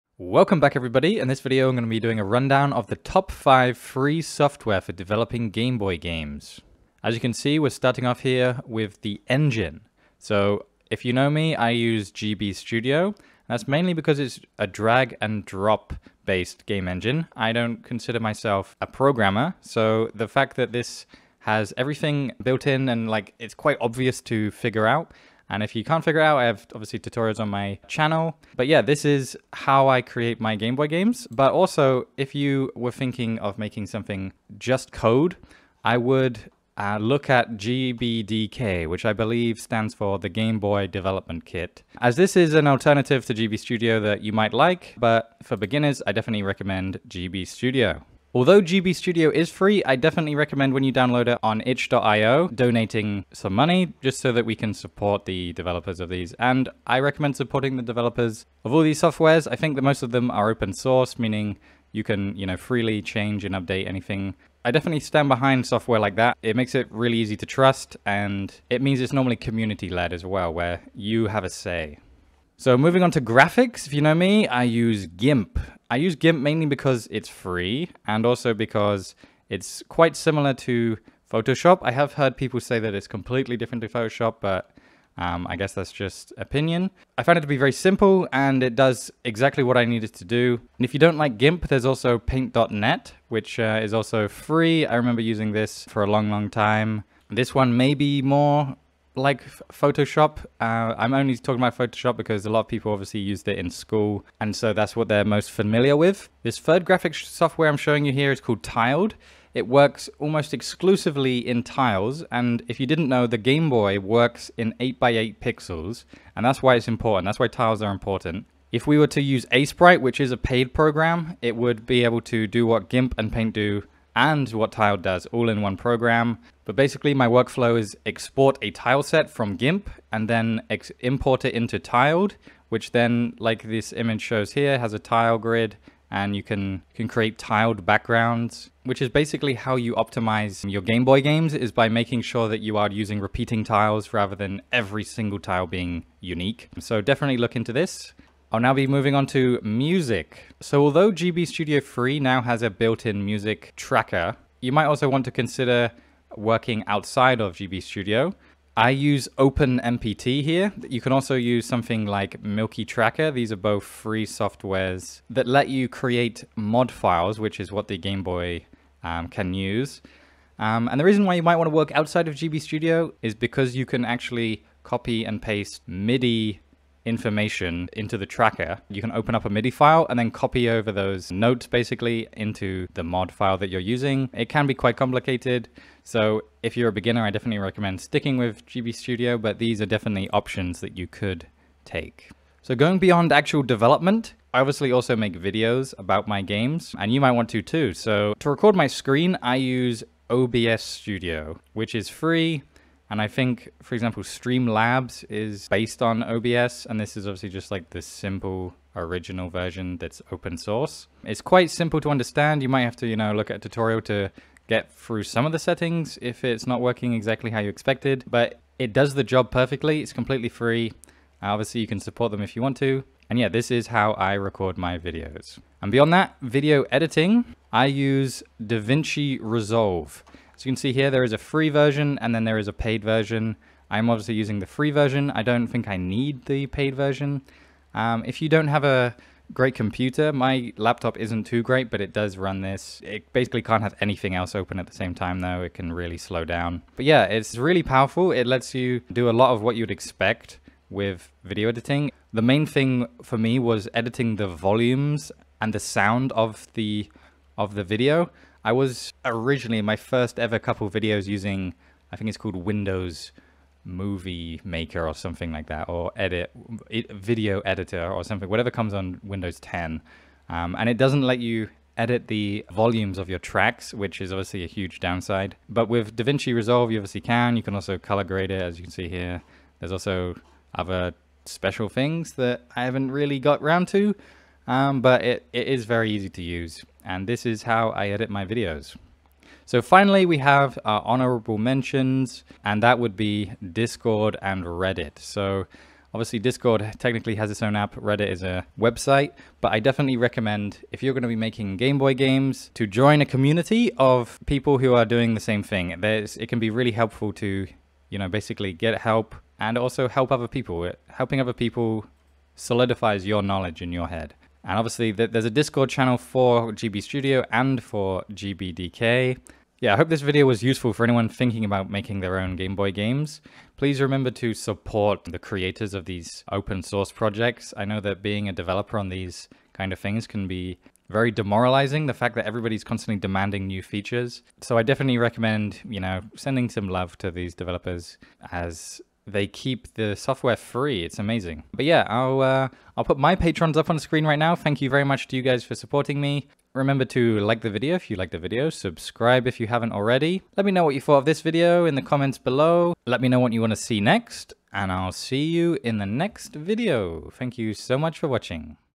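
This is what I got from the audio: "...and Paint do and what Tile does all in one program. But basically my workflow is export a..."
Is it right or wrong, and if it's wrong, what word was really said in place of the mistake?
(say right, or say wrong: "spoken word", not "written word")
right.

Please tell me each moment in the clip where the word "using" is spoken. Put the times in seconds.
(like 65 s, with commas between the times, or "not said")
95 s, 142 s, 183 s, 234 s, 261 s.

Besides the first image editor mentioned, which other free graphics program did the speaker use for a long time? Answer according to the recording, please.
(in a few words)
paint.net.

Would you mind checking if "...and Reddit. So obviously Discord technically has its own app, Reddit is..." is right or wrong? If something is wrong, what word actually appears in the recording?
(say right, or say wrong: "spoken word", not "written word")
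right.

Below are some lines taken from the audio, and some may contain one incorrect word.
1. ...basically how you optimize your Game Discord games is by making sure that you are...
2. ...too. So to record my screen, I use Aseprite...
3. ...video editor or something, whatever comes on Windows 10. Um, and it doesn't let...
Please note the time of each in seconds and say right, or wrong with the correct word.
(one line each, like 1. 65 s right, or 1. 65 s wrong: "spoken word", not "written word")
1. 139 s wrong: "Boy", not "Discord"
2. 197 s wrong: "OBS", not "Aseprite"
3. 266 s right.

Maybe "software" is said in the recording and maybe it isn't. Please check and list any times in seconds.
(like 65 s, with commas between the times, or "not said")
4 s, 59 s, 65 s, 107 s, 164 s, 340 s.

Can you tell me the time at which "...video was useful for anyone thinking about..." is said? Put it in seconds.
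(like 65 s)
320 s.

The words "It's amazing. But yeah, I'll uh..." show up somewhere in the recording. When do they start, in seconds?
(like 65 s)
341 s.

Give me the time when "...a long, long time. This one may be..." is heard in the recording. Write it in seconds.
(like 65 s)
96 s.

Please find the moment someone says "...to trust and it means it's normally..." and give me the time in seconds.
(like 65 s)
67 s.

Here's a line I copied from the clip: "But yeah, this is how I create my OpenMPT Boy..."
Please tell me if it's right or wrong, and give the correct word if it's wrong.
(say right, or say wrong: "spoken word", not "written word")
wrong: "Game", not "OpenMPT".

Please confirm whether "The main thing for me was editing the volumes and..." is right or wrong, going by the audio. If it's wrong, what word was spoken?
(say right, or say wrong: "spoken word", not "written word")
right.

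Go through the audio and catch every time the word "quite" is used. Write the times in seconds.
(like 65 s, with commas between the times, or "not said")
23 s, 79 s, 184 s, 211 s.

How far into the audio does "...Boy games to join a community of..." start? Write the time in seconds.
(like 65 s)
301 s.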